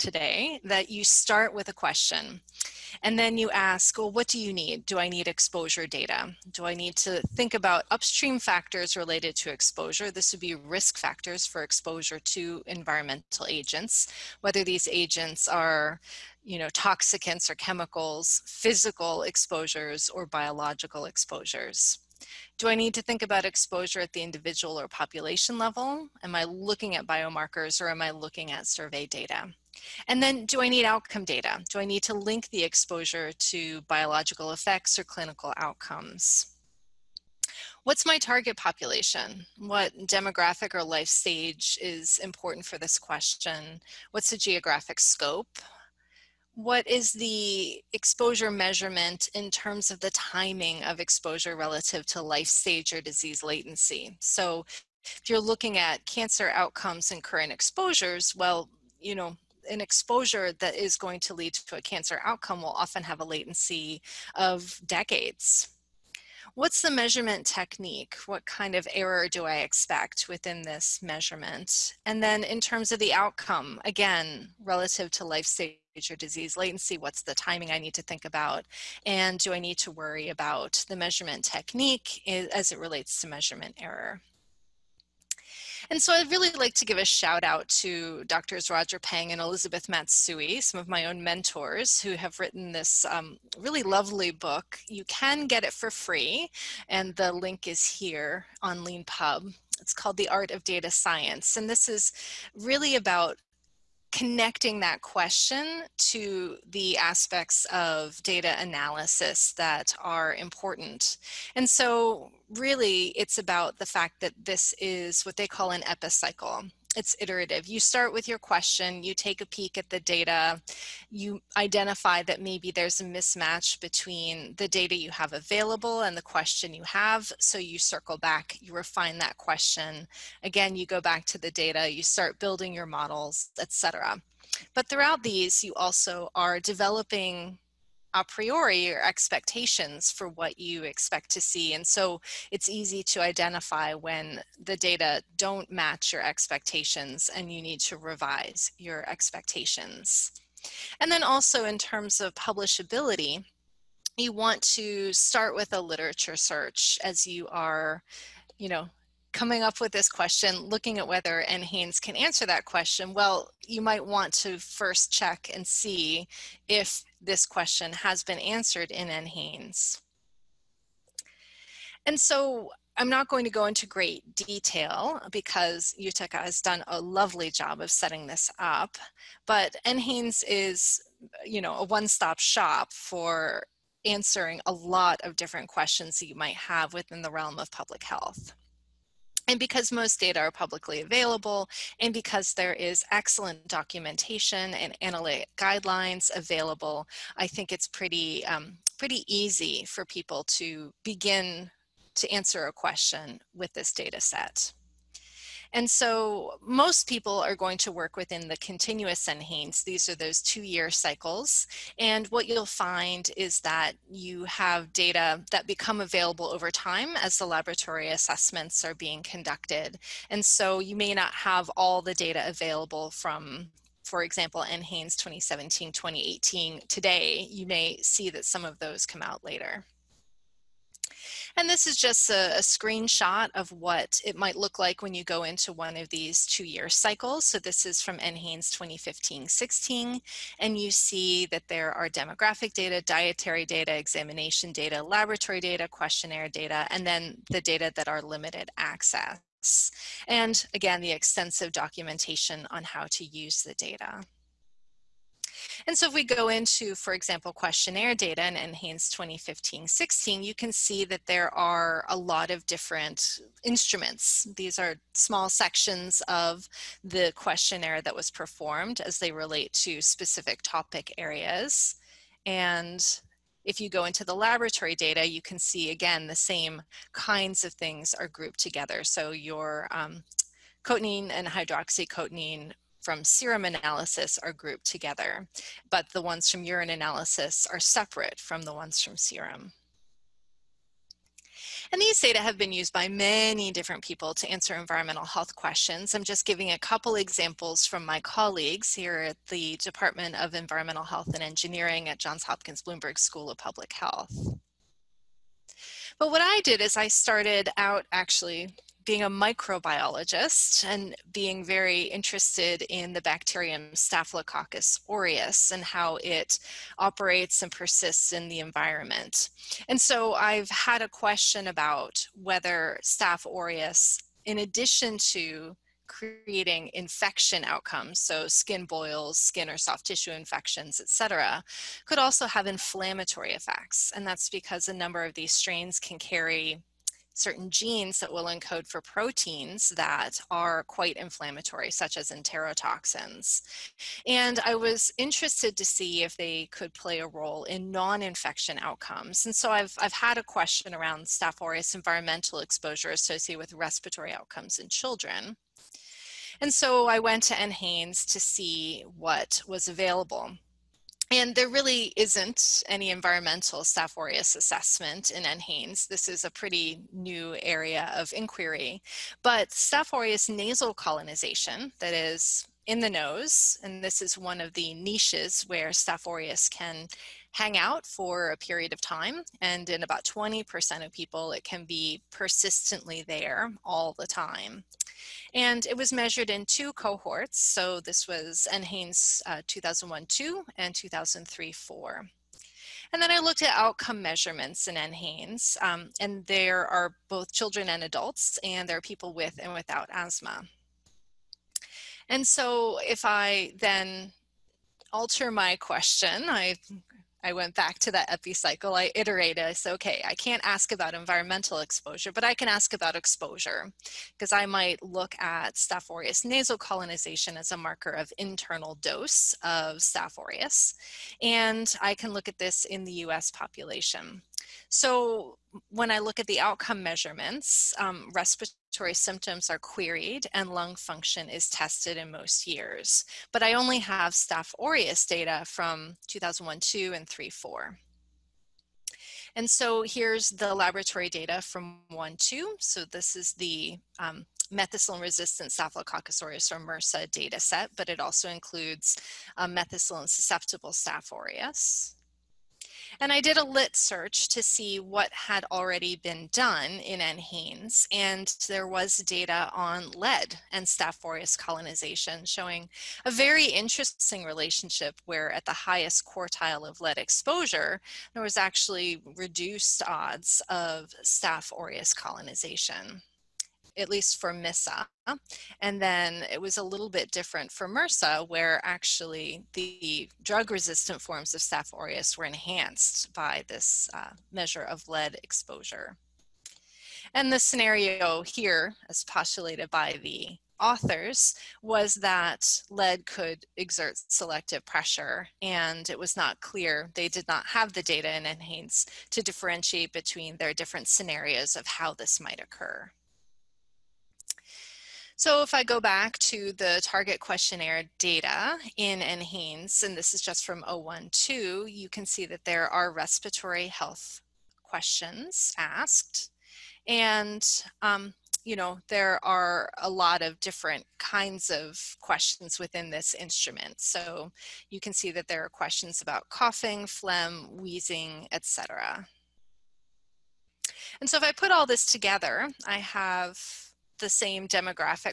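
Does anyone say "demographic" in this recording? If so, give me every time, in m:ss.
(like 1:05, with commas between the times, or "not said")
0:40, 4:02, 8:54.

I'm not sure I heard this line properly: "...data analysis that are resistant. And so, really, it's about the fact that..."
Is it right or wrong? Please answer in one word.
wrong.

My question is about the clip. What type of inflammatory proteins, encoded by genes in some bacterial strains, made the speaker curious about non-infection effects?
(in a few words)
enterotoxins.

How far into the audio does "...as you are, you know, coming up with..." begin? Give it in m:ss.
2:37.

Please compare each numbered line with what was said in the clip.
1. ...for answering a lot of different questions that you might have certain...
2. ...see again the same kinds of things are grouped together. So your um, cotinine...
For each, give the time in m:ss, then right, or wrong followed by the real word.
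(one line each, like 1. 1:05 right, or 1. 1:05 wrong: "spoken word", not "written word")
1. 3:02 wrong: "within", not "certain"
2. 4:35 right.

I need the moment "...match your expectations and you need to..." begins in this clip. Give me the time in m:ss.
2:25.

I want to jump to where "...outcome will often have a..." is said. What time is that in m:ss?
1:02.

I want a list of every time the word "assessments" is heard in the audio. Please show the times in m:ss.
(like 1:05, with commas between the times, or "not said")
3:38, 6:04.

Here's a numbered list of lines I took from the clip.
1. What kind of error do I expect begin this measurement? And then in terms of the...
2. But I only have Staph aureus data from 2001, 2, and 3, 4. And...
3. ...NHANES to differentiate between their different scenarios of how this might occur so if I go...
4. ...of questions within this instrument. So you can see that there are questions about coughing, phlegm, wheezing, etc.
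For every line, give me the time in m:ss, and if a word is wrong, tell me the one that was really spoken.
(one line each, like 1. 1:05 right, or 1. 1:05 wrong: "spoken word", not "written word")
1. 1:08 wrong: "within", not "begin"
2. 7:13 right
3. 8:18 right
4. 8:41 right.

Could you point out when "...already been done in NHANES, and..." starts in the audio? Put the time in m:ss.
7:35.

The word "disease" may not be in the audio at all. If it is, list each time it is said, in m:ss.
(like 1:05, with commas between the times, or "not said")
0:53, 1:16.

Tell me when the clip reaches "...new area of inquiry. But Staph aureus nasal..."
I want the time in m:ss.
6:07.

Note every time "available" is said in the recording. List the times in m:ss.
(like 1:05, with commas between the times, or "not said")
2:05, 3:11, 3:16, 3:35, 3:42, 5:59.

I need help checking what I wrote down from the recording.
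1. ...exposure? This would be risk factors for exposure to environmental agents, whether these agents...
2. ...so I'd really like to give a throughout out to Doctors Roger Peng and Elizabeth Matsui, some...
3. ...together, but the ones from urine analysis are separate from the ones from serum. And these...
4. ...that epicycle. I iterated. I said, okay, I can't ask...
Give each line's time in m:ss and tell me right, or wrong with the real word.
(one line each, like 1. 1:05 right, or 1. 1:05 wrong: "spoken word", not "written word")
1. 0:09 right
2. 1:26 wrong: "shout", not "throughout"
3. 4:44 right
4. 6:48 right.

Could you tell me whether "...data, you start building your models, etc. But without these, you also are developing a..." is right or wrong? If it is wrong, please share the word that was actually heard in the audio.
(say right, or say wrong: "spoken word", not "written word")
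wrong: "throughout", not "without".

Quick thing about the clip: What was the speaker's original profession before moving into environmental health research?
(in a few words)
microbiologist.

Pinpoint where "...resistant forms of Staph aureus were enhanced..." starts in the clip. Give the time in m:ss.
8:00.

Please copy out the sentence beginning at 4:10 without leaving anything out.
And again, the extensive documentation on how to use the data.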